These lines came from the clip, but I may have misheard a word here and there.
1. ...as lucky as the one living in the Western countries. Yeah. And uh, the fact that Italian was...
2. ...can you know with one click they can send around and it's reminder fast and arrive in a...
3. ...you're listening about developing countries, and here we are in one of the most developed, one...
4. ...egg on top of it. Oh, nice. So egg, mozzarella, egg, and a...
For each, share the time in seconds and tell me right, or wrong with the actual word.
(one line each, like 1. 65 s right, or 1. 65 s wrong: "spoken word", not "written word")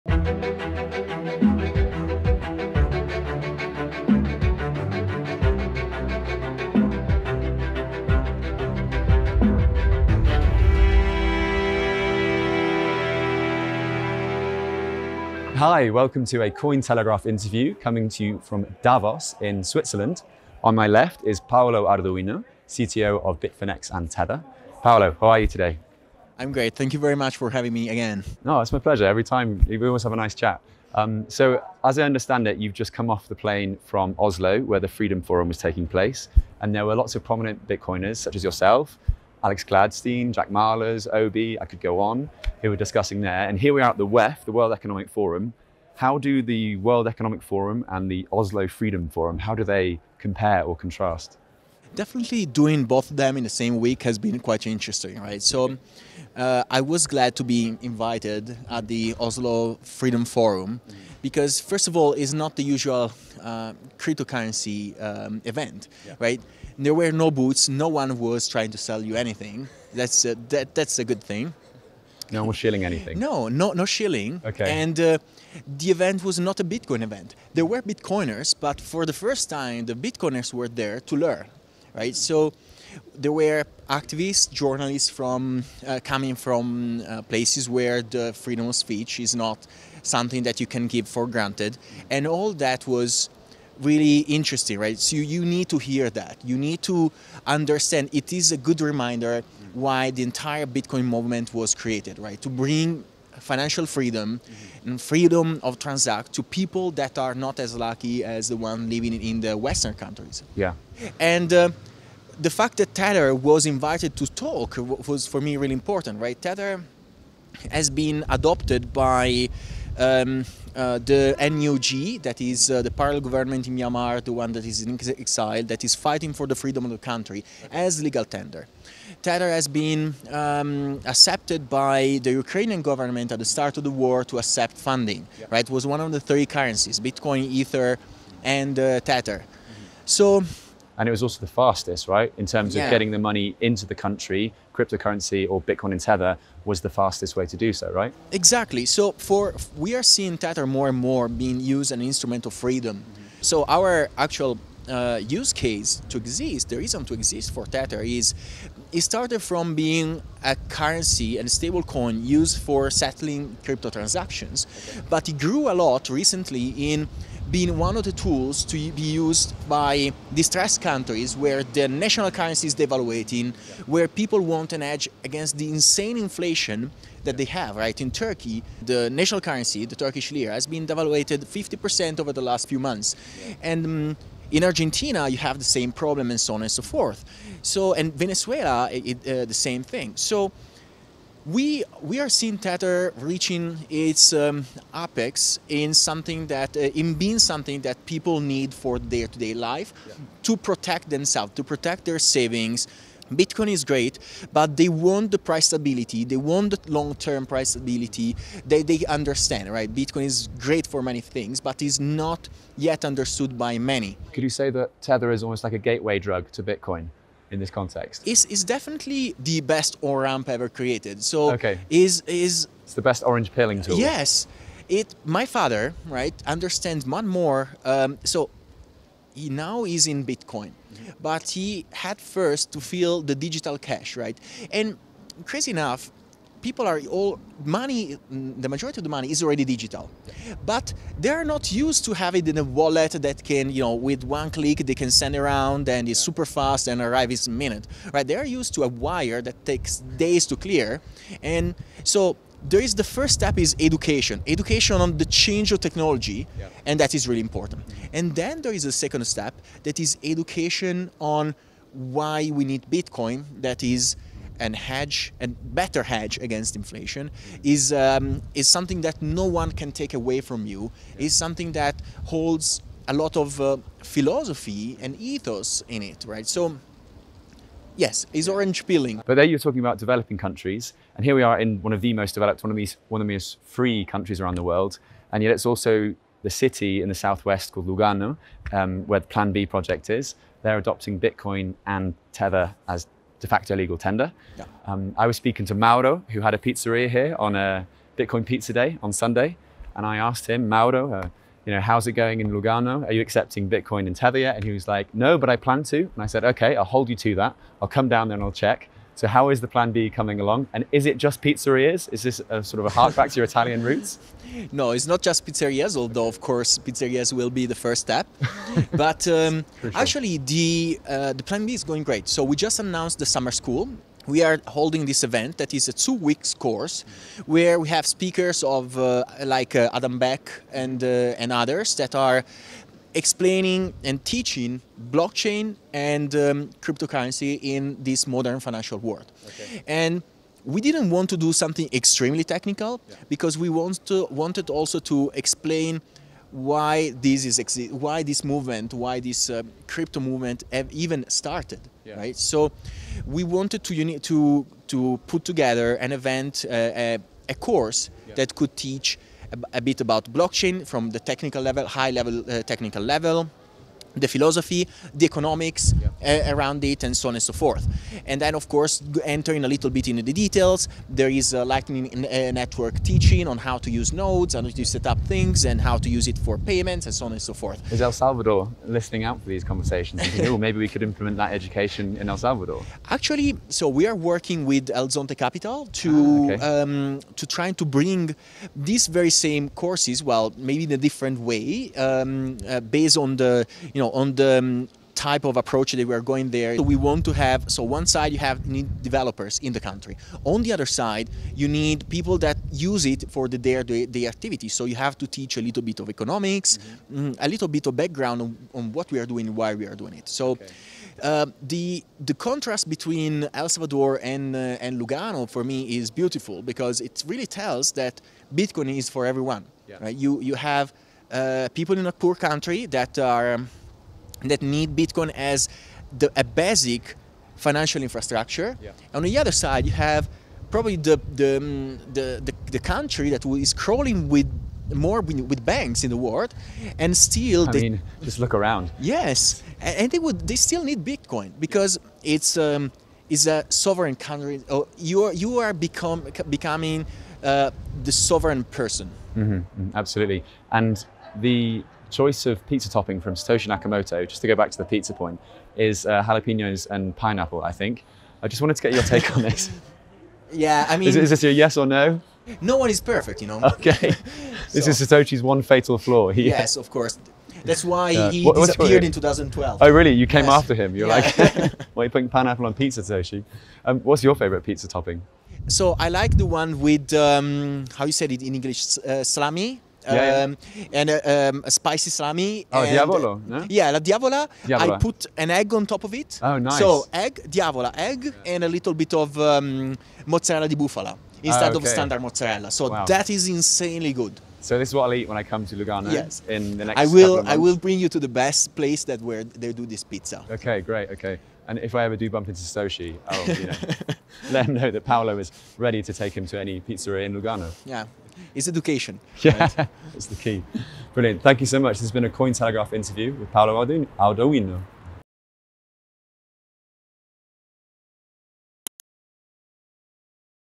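1. 107 s wrong: "Tether", not "Italian"
2. 243 s wrong: "super", not "reminder"
3. 279 s wrong: "talking", not "listening"
4. 485 s wrong: "diavola", not "mozzarella".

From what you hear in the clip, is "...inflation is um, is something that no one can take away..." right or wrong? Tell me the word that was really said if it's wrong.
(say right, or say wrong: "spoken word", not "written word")
right.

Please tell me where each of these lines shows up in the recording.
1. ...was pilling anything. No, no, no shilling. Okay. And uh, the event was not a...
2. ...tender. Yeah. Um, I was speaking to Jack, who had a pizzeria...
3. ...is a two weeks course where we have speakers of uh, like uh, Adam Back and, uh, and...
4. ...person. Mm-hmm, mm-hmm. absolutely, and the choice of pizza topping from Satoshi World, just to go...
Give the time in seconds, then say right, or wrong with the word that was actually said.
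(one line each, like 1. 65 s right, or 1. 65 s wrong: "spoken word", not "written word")
1. 72 s wrong: "shilling", not "pilling"
2. 293 s wrong: "Mauro", not "Jack"
3. 325 s right
4. 448 s wrong: "Nakamoto", not "World".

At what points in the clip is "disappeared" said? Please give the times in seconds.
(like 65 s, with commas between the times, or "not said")
468 s.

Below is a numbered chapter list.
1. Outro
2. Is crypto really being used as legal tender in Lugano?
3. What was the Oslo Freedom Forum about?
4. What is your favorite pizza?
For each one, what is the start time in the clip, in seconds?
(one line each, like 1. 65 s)
1. 500 s
2. 279 s
3. 15 s
4. 449 s.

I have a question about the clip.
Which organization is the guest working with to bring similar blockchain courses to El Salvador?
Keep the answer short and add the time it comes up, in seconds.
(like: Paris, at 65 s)
El Zonte Capital, at 384 s.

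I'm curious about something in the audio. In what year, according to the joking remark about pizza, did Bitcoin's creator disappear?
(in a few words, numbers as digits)
2012.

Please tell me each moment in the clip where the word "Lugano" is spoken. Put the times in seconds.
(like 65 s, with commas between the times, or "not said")
287 s, 302 s, 415 s, 495 s, 507 s.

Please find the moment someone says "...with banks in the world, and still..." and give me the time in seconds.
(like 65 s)
435 s.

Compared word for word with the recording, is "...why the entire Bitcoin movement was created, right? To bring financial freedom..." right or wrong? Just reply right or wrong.
right.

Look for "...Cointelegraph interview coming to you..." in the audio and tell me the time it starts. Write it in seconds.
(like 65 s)
16 s.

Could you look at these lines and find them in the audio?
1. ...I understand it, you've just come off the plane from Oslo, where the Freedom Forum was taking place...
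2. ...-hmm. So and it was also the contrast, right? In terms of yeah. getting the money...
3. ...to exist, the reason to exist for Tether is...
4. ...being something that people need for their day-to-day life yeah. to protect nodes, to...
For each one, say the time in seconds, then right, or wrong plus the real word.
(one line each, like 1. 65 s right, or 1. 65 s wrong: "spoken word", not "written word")
1. 31 s right
2. 139 s wrong: "fastest", not "contrast"
3. 156 s right
4. 197 s wrong: "themselves", not "nodes".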